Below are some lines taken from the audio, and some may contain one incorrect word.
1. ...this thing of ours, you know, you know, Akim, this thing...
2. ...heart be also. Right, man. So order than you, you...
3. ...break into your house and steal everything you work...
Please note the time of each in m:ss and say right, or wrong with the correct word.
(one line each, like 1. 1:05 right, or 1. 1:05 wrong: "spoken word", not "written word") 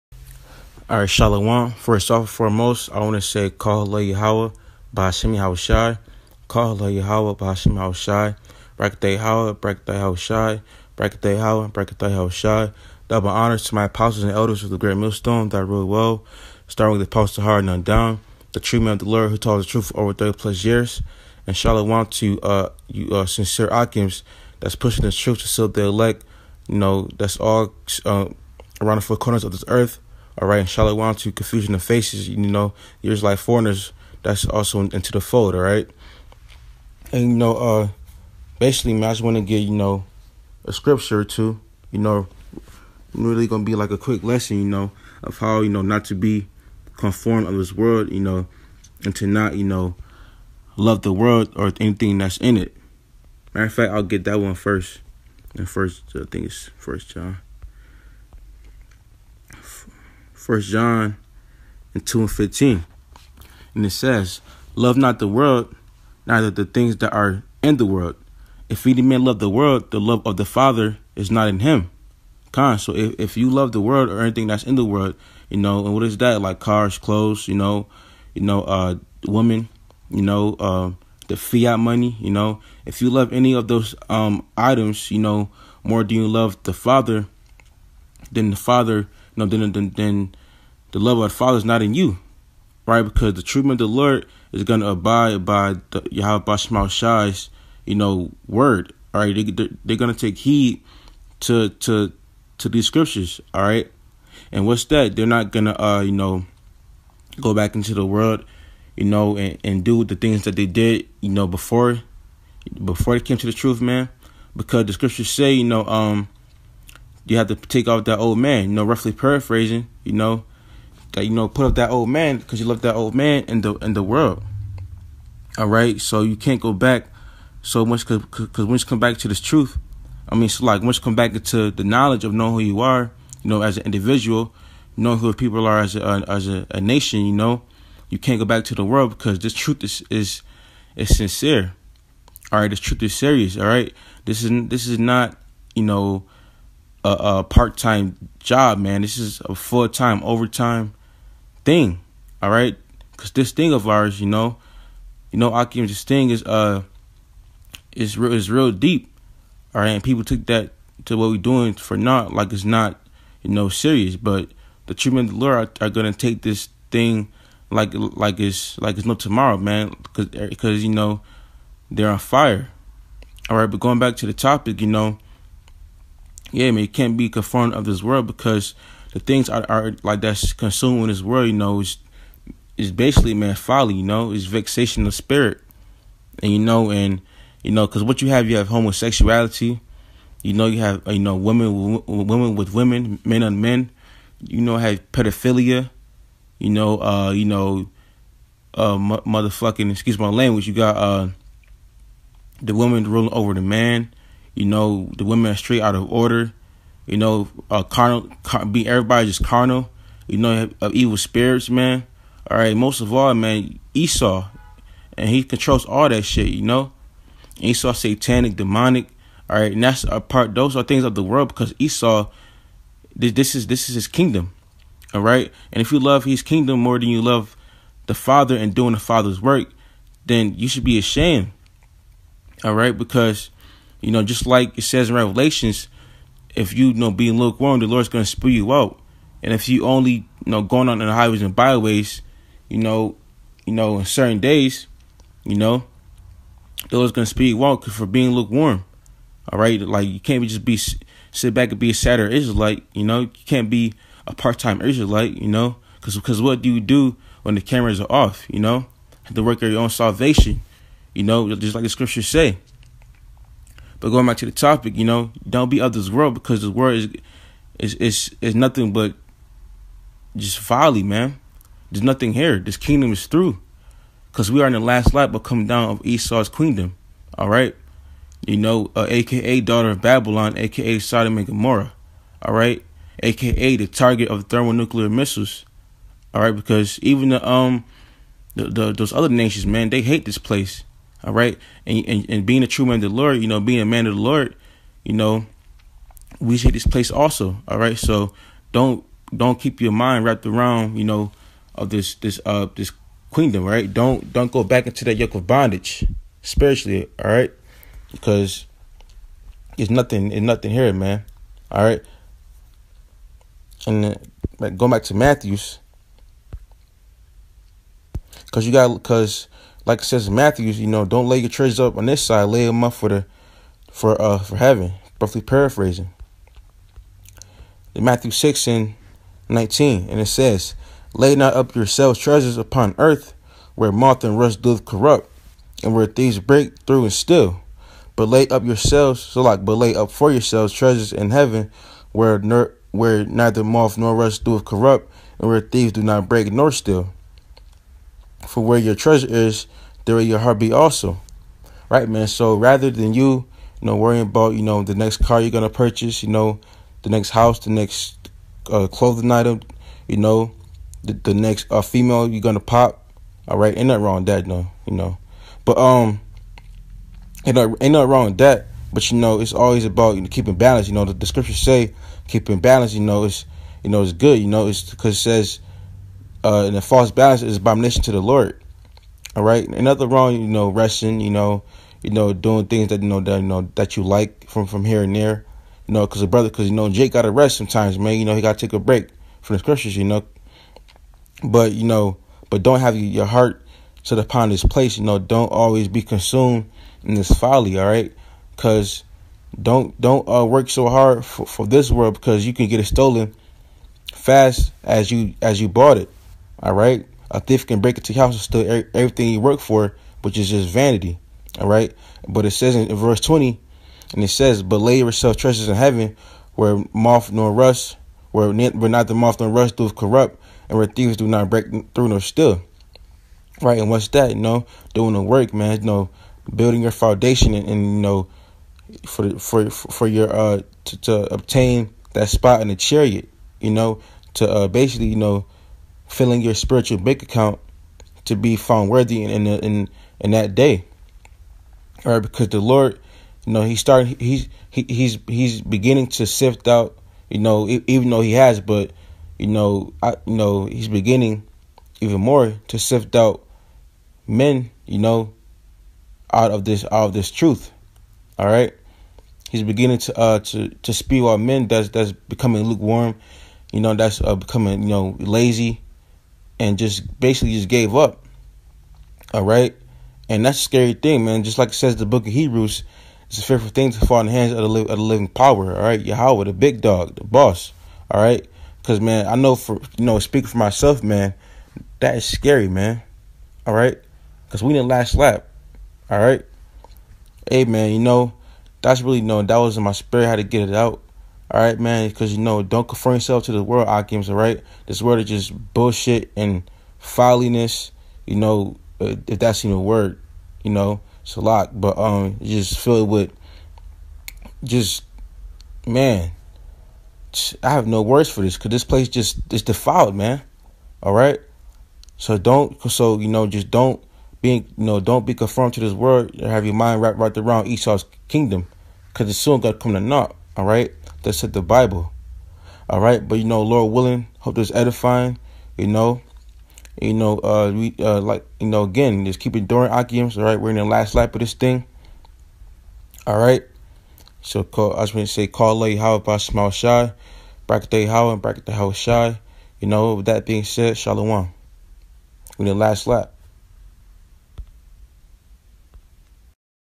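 1. 2:33 right
2. 5:50 wrong: "rather", not "order"
3. 6:47 right.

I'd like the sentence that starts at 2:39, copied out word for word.
And people took that to what we're doing for not like it's not, you know, serious.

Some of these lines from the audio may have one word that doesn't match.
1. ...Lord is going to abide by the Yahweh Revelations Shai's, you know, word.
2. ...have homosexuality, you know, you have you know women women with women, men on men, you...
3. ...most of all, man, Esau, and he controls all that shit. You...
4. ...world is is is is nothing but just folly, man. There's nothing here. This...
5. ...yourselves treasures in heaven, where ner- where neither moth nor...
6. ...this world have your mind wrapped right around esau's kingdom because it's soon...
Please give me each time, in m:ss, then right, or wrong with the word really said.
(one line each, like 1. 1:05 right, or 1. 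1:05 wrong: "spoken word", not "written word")
1. 1:33 wrong: "Shema", not "Revelations"
2. 3:08 right
3. 3:32 right
4. 4:26 right
5. 5:40 right
6. 8:35 right.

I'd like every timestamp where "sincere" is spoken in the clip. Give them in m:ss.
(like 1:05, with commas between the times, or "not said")
0:23, 2:21.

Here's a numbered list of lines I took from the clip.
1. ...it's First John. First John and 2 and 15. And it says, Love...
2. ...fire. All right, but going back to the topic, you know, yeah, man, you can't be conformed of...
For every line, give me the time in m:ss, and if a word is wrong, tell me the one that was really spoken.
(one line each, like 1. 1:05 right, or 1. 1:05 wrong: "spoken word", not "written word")
1. 0:56 right
2. 2:52 right.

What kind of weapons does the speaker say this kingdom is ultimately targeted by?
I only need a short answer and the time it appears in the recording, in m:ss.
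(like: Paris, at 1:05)
thermonuclear missiles, at 4:44.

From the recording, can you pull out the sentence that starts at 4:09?
All right, like you can't just be sit back and be a sadder Israelite.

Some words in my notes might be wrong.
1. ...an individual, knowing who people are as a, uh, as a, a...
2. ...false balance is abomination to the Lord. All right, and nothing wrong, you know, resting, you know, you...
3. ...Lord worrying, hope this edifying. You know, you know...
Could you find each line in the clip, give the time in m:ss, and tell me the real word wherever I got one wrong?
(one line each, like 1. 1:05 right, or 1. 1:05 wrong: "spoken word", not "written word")
1. 2:13 right
2. 6:16 right
3. 8:43 wrong: "willing", not "worrying".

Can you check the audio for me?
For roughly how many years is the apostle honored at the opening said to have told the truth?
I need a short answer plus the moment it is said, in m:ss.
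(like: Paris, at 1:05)
30 plus, at 0:20.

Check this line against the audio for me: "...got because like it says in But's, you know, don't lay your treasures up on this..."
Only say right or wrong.
wrong.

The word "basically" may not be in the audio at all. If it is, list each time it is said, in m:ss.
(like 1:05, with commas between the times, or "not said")
0:38, 3:02, 7:14, 7:47.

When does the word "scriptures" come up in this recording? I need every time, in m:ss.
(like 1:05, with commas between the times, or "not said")
0:40, 1:42, 1:54, 4:21, 6:11, 6:29.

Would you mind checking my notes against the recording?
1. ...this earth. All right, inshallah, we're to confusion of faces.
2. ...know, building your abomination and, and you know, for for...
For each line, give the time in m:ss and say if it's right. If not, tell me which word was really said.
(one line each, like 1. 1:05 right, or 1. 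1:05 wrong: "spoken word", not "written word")
1. 0:29 right
2. 7:05 wrong: "foundation", not "abomination".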